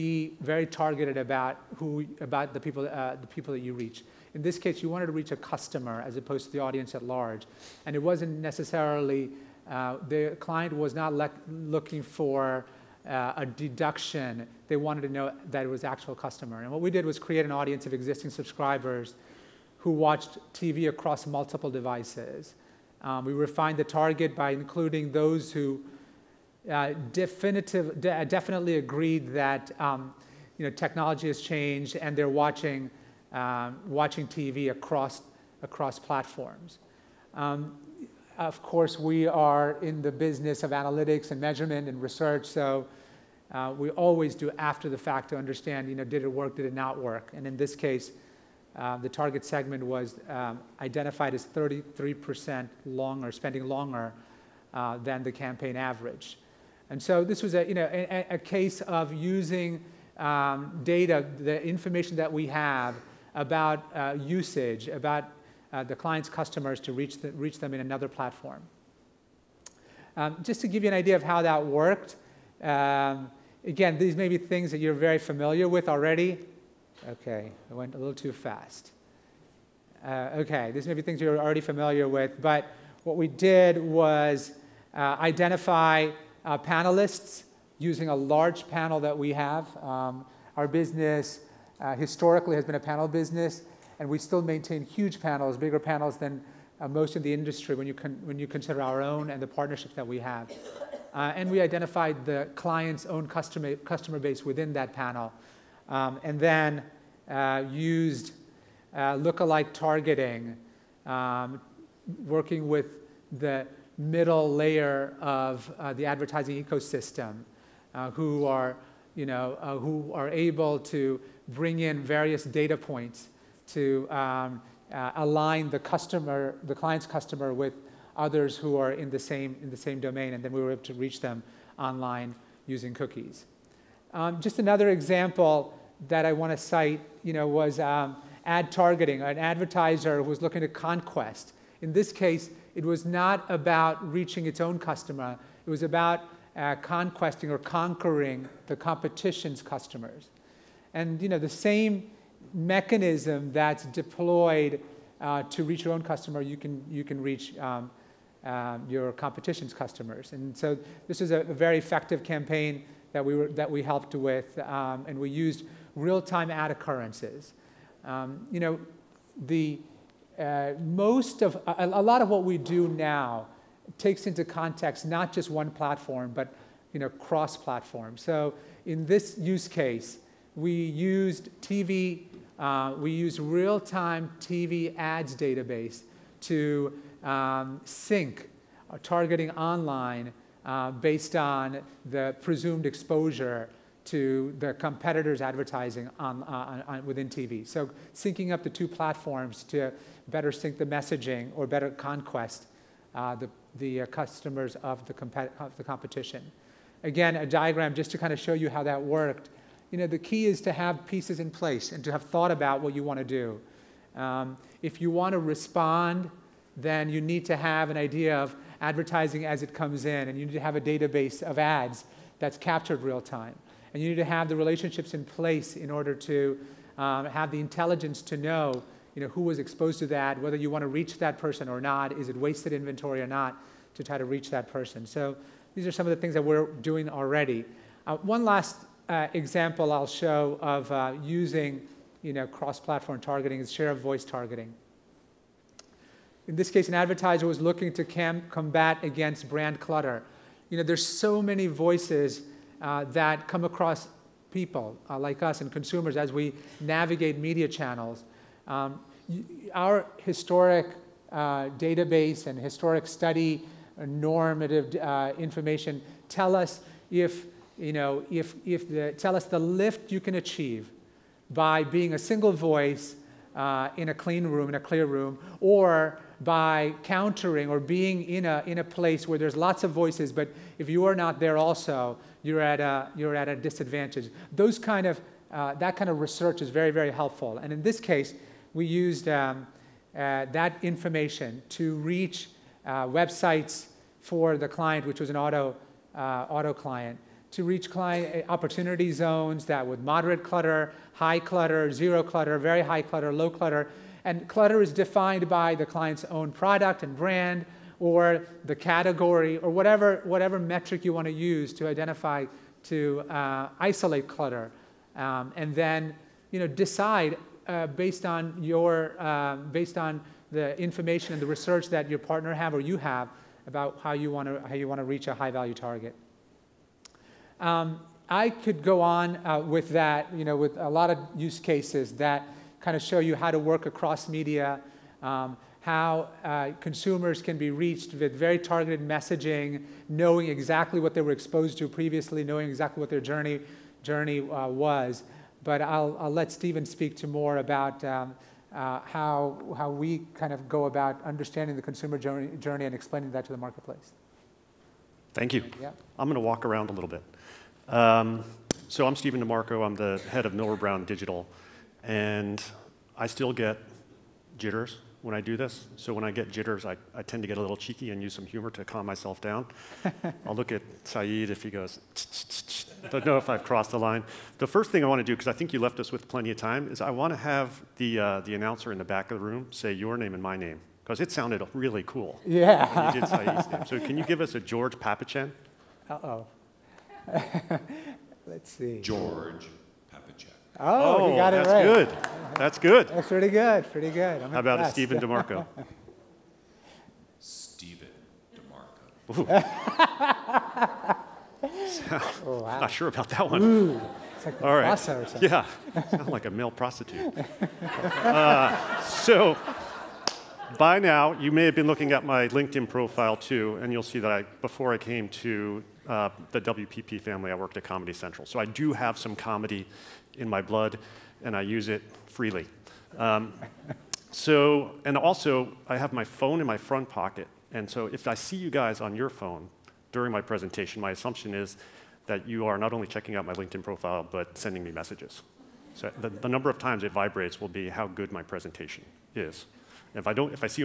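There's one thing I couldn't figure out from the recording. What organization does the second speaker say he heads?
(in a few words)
Millward Brown Digital.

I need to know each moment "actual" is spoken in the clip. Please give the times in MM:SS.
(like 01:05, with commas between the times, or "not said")
00:15.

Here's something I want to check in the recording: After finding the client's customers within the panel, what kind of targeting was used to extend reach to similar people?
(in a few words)
lookalike targeting.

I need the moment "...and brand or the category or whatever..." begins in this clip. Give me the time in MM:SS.
05:07.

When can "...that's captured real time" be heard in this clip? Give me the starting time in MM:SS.
03:42.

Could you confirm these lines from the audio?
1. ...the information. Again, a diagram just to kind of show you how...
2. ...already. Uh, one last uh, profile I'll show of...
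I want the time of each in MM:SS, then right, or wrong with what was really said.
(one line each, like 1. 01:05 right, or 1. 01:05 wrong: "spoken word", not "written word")
1. 03:25 wrong: "competition", not "information"
2. 03:57 wrong: "example", not "profile".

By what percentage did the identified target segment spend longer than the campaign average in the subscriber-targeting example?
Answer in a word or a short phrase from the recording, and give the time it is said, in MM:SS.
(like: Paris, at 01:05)
33%, at 00:51.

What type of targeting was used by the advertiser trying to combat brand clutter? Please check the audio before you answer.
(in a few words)
share of voice targeting.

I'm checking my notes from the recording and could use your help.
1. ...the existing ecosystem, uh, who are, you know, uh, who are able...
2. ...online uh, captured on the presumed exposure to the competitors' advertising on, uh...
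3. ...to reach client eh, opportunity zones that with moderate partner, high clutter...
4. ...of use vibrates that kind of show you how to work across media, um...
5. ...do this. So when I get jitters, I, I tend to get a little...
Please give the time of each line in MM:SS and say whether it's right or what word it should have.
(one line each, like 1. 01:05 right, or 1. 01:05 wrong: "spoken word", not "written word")
1. 01:55 wrong: "advertising", not "existing"
2. 03:09 wrong: "based", not "captured"
3. 04:57 wrong: "clutter", not "partner"
4. 05:31 wrong: "cases", not "vibrates"
5. 06:05 right.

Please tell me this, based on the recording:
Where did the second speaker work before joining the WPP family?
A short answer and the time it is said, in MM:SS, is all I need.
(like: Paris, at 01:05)
Comedy Central, at 06:57.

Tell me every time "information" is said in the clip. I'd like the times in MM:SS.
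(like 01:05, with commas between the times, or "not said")
01:01, 04:25, 04:50, 05:20.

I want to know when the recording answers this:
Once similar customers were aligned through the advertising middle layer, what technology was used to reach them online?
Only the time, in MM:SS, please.
02:12.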